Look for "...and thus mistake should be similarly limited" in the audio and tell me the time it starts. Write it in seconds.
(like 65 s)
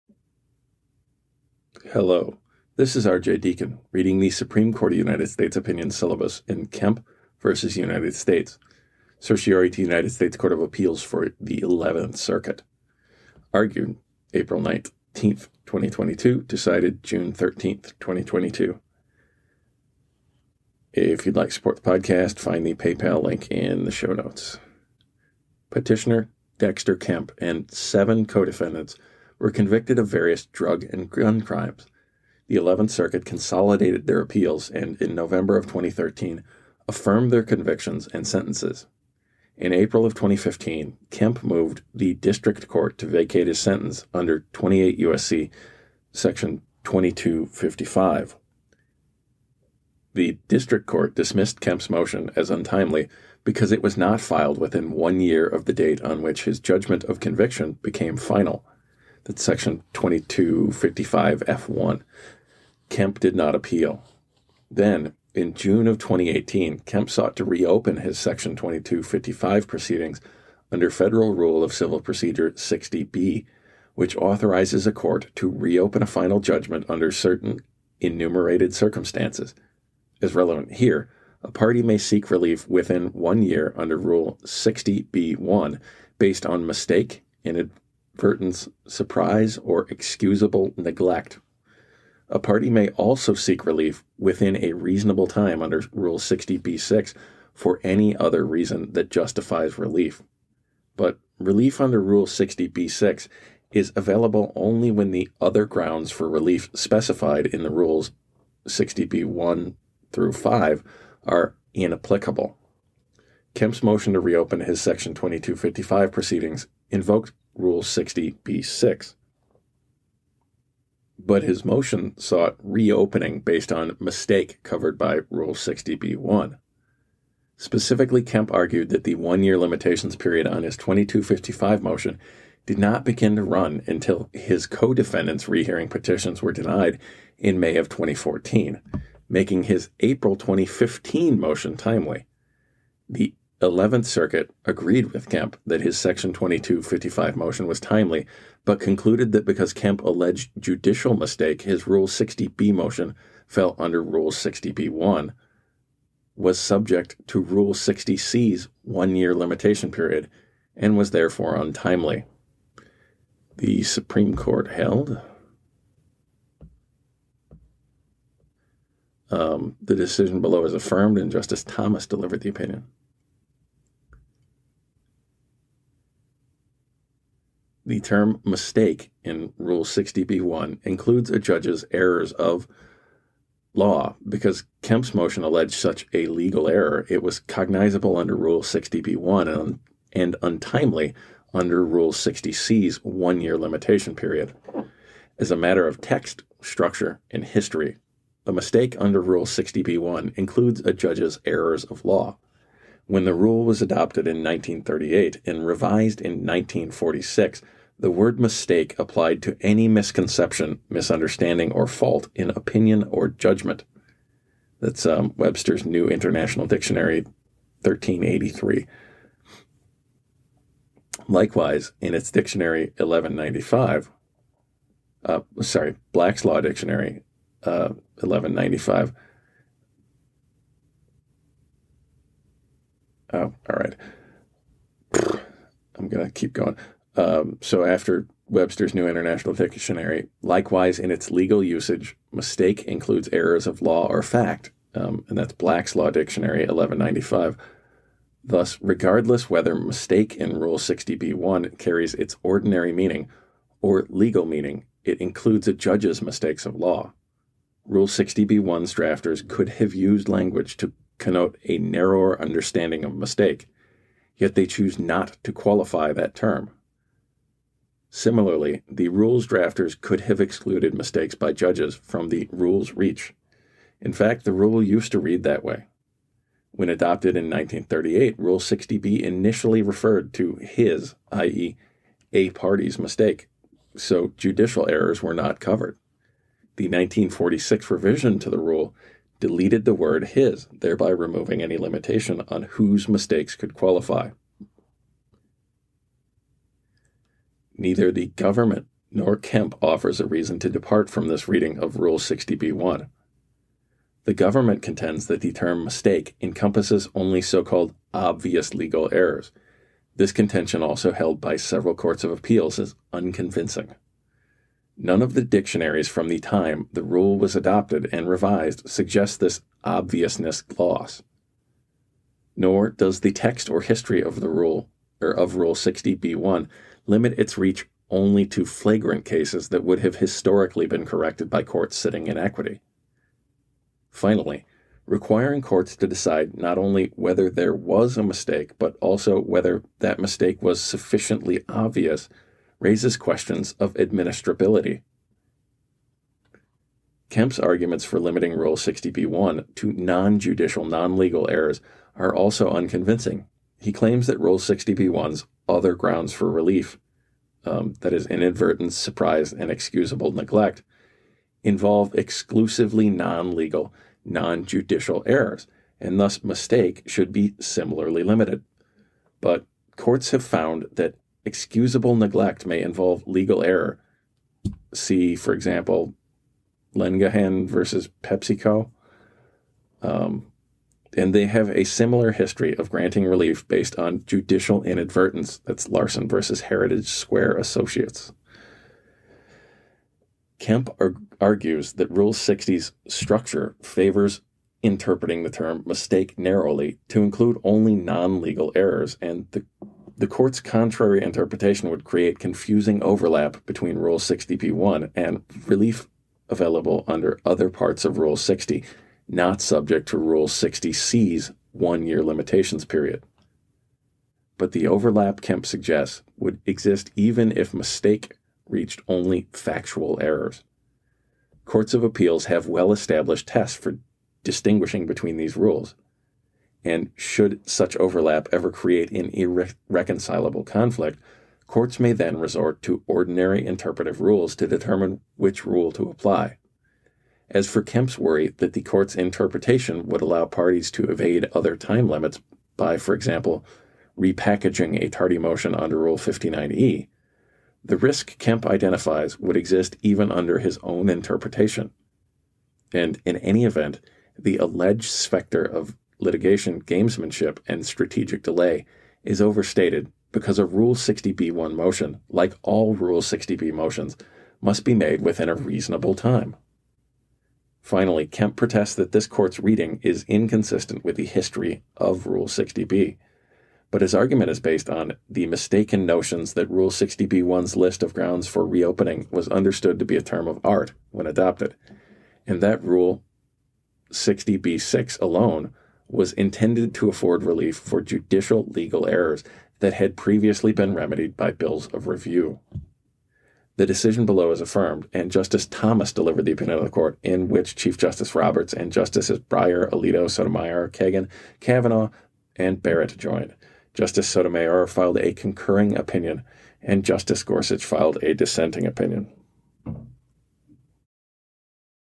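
365 s.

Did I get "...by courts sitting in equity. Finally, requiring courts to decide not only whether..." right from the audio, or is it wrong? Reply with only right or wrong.
right.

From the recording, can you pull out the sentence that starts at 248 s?
Thus, regardless whether mistake in Rule 60b1 carries its ordinary meaning or legal meaning, it includes a judge's mistakes of law.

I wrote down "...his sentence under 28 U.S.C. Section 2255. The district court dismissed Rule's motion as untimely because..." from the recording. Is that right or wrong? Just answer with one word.
wrong.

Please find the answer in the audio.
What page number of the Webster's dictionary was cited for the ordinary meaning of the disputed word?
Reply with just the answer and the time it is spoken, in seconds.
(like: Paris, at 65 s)
1383, at 217 s.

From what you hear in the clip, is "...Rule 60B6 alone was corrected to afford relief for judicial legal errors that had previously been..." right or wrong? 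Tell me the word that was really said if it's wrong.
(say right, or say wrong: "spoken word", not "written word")
wrong: "intended", not "corrected".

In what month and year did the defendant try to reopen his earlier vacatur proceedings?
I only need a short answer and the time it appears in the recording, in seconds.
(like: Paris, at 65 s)
June 2018, at 65 s.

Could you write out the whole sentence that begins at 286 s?
The 1946 revision to the rule deleted the word his, thereby removing any limitation on whose mistakes could qualify.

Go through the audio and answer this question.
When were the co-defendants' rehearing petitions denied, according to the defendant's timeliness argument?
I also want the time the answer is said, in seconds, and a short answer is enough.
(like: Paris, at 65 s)
May 2014, at 137 s.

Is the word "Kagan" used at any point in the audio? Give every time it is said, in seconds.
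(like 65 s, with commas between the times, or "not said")
500 s.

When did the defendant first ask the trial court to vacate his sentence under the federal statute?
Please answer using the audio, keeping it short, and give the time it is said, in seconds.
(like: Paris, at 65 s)
April 2015, at 39 s.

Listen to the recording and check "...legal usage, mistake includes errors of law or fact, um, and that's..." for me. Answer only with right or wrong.
right.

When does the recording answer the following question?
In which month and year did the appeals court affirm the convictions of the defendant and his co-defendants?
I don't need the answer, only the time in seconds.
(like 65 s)
35 s.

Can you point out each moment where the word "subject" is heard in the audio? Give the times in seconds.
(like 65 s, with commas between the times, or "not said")
156 s, 409 s.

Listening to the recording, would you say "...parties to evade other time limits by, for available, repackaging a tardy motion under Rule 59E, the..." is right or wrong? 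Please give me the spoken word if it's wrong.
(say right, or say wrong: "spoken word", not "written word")
wrong: "example", not "available".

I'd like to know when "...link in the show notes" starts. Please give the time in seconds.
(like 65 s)
23 s.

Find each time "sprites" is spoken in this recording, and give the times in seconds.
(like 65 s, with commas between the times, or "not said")
not said.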